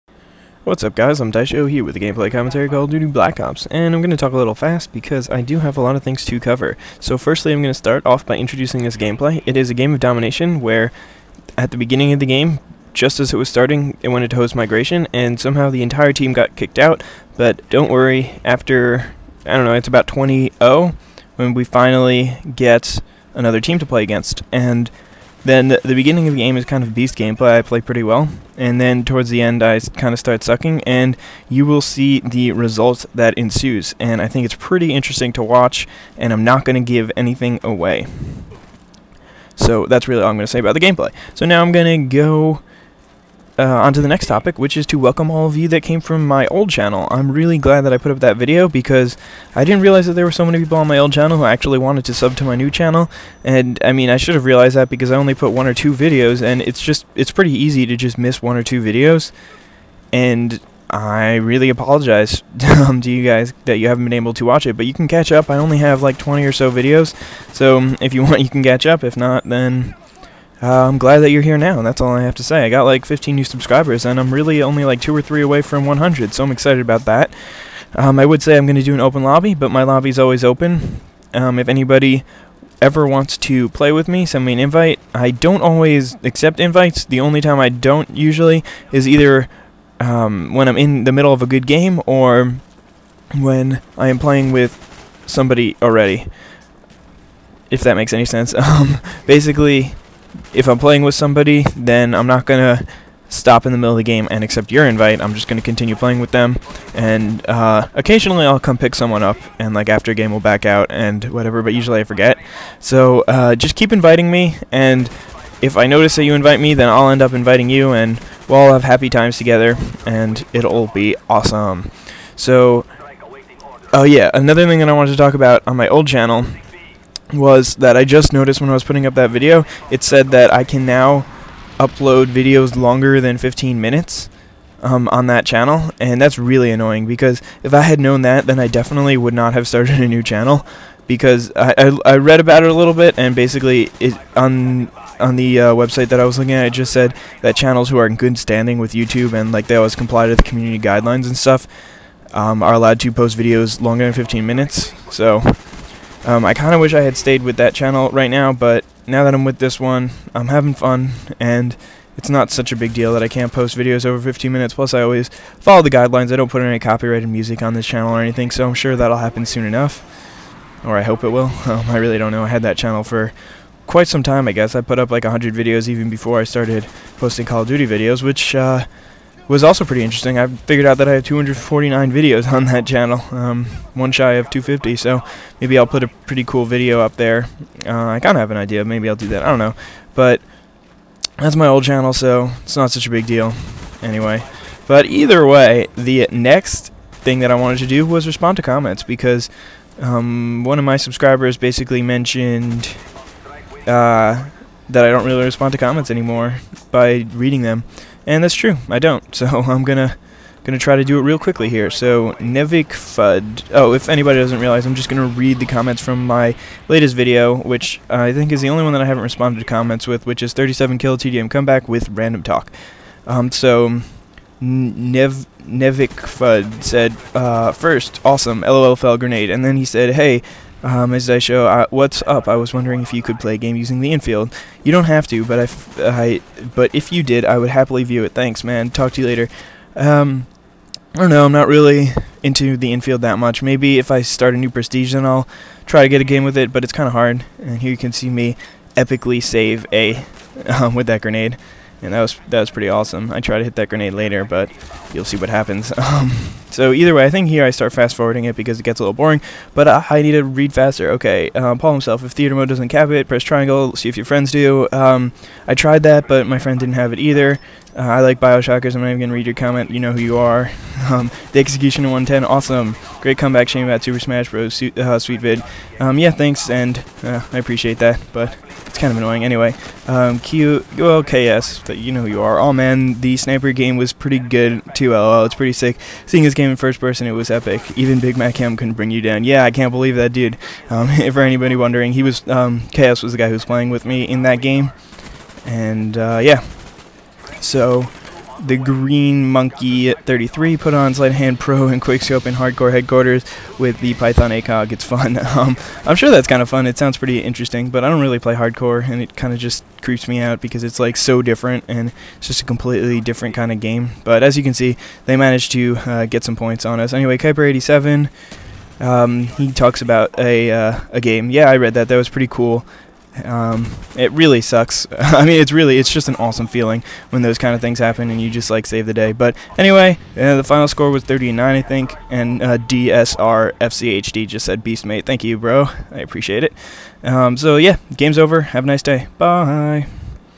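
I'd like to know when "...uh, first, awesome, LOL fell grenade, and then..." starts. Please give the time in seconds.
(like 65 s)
227 s.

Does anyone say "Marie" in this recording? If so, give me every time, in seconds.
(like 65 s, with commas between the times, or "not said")
not said.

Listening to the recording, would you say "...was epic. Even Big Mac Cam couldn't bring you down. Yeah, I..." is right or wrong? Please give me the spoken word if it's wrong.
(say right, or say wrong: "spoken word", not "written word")
right.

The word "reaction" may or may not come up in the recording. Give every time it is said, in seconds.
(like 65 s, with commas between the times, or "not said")
not said.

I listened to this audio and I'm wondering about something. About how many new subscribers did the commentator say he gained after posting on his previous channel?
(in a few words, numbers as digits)
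15.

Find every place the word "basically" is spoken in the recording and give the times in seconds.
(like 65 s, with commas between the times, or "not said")
99 s, 143 s, 201 s.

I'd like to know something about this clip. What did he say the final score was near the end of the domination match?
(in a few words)
39.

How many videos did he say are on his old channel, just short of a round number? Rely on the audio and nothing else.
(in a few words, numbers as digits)
249.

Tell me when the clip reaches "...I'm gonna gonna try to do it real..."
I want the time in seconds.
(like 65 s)
209 s.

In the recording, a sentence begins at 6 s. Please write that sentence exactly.
So firstly I'm going to start off by introducing this gameplay.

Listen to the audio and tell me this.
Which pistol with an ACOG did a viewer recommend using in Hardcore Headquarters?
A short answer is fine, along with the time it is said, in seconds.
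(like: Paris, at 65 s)
Python, at 304 s.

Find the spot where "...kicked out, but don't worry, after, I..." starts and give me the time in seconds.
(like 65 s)
16 s.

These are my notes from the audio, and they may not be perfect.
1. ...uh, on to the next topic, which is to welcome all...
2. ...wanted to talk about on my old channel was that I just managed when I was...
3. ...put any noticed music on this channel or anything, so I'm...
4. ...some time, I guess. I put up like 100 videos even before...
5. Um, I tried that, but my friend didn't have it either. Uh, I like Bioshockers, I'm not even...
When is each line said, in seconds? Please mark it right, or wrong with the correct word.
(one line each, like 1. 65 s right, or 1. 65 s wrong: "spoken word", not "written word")
1. 43 s right
2. 124 s wrong: "noticed", not "managed"
3. 166 s wrong: "copyrighted", not "noticed"
4. 174 s right
5. 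264 s right.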